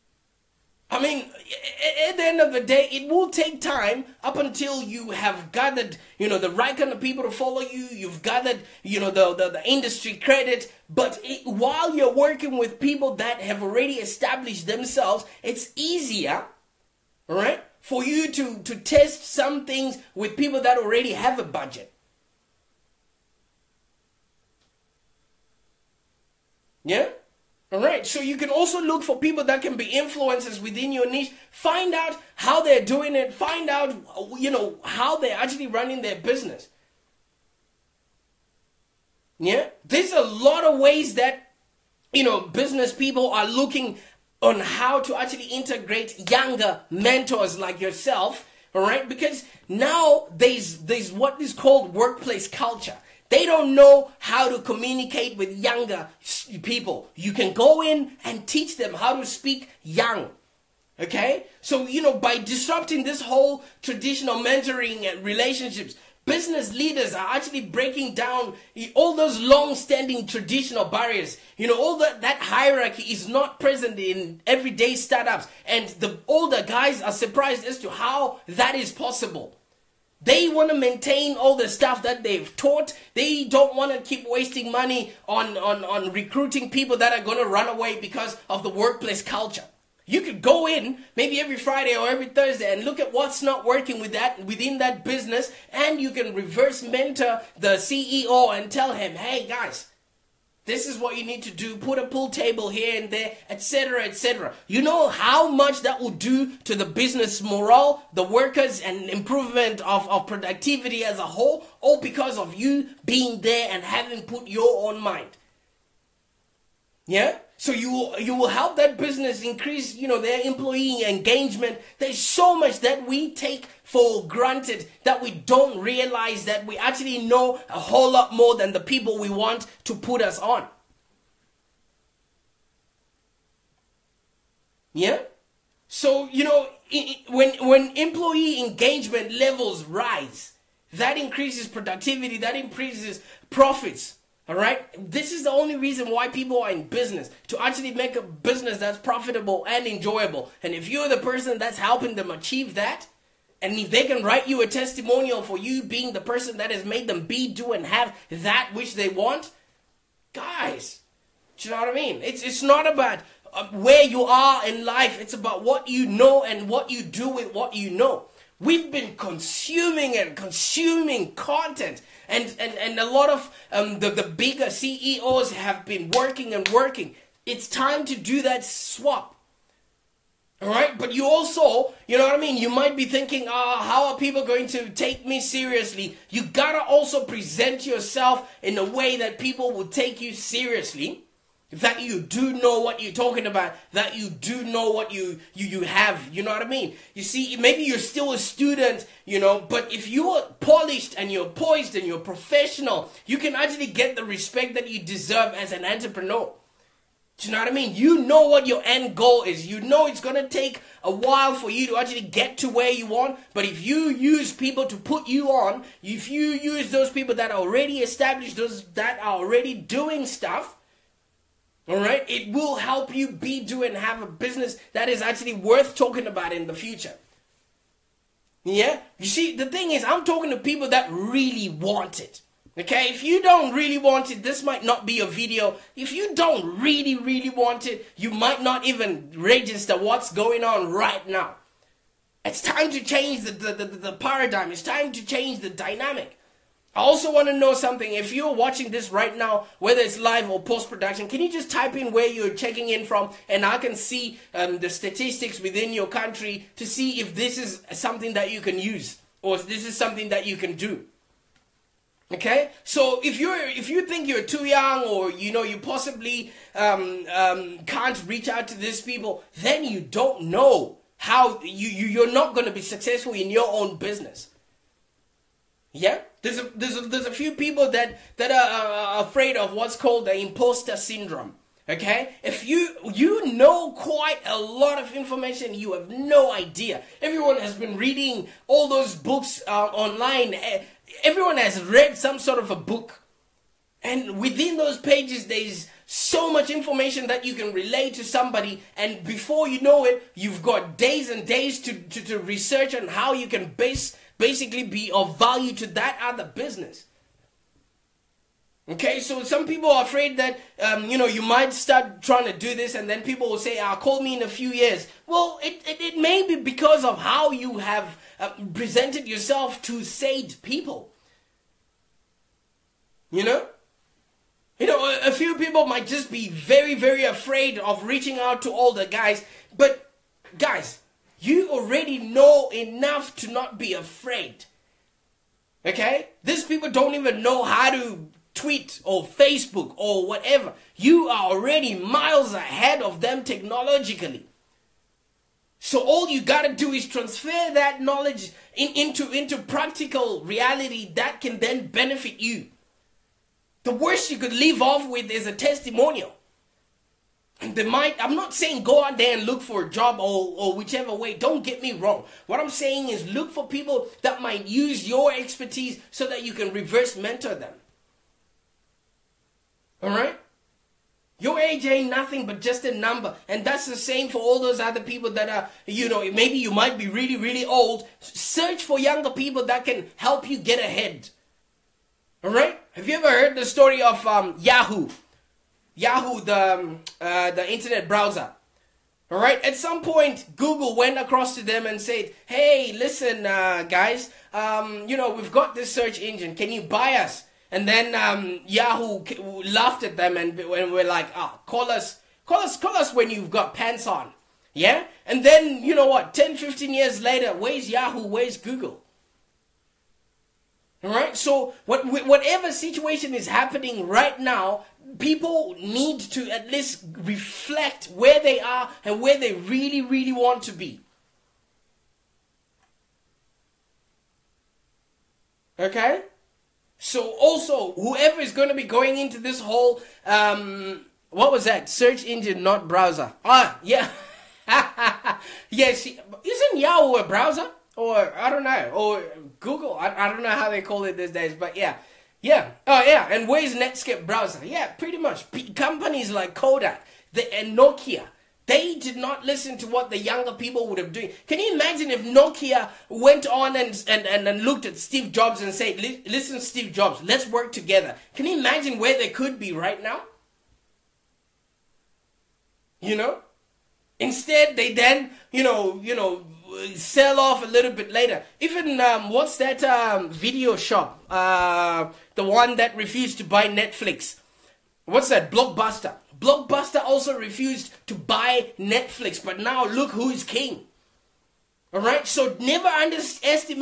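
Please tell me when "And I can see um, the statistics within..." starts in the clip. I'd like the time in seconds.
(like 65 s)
253 s.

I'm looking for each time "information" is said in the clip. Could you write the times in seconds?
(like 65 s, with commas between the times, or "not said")
285 s, 296 s.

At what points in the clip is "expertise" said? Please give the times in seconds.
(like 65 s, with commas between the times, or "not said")
365 s.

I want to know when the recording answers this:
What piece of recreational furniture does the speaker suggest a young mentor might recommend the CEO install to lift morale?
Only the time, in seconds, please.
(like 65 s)
102 s.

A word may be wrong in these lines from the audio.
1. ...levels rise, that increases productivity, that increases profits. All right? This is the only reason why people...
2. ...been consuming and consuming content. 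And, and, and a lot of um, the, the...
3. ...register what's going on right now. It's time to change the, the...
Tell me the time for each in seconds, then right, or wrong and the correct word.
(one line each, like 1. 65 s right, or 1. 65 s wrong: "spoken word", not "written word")
1. 139 s right
2. 168 s right
3. 239 s right.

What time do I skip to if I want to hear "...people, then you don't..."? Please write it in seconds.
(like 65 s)
268 s.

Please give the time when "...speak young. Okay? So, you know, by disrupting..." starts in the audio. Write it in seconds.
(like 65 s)
59 s.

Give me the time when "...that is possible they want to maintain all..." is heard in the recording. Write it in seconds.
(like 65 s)
78 s.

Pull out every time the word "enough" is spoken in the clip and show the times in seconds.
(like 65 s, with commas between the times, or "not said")
332 s.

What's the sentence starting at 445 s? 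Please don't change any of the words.
P- companies like Kodak the, and Nokia, they did not listen to what the younger people would have doing.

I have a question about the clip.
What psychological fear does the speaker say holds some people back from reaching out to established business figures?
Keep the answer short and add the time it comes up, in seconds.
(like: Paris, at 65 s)
imposter syndrome, at 280 s.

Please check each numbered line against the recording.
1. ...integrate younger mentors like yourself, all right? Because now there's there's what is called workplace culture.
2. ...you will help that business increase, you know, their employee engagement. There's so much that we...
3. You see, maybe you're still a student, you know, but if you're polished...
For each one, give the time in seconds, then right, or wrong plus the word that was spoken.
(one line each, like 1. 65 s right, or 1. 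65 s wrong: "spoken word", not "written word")
1. 45 s right
2. 118 s right
3. 197 s right.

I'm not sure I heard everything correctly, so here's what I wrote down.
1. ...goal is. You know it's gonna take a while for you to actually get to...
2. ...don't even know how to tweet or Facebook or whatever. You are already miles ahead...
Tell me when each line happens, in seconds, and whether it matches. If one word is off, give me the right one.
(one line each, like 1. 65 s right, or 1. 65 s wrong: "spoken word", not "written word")
1. 209 s right
2. 336 s right.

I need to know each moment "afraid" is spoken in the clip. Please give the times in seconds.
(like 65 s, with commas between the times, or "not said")
279 s, 310 s, 327 s, 333 s.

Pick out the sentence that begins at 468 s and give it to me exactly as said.
Even um, what's that um, video shop?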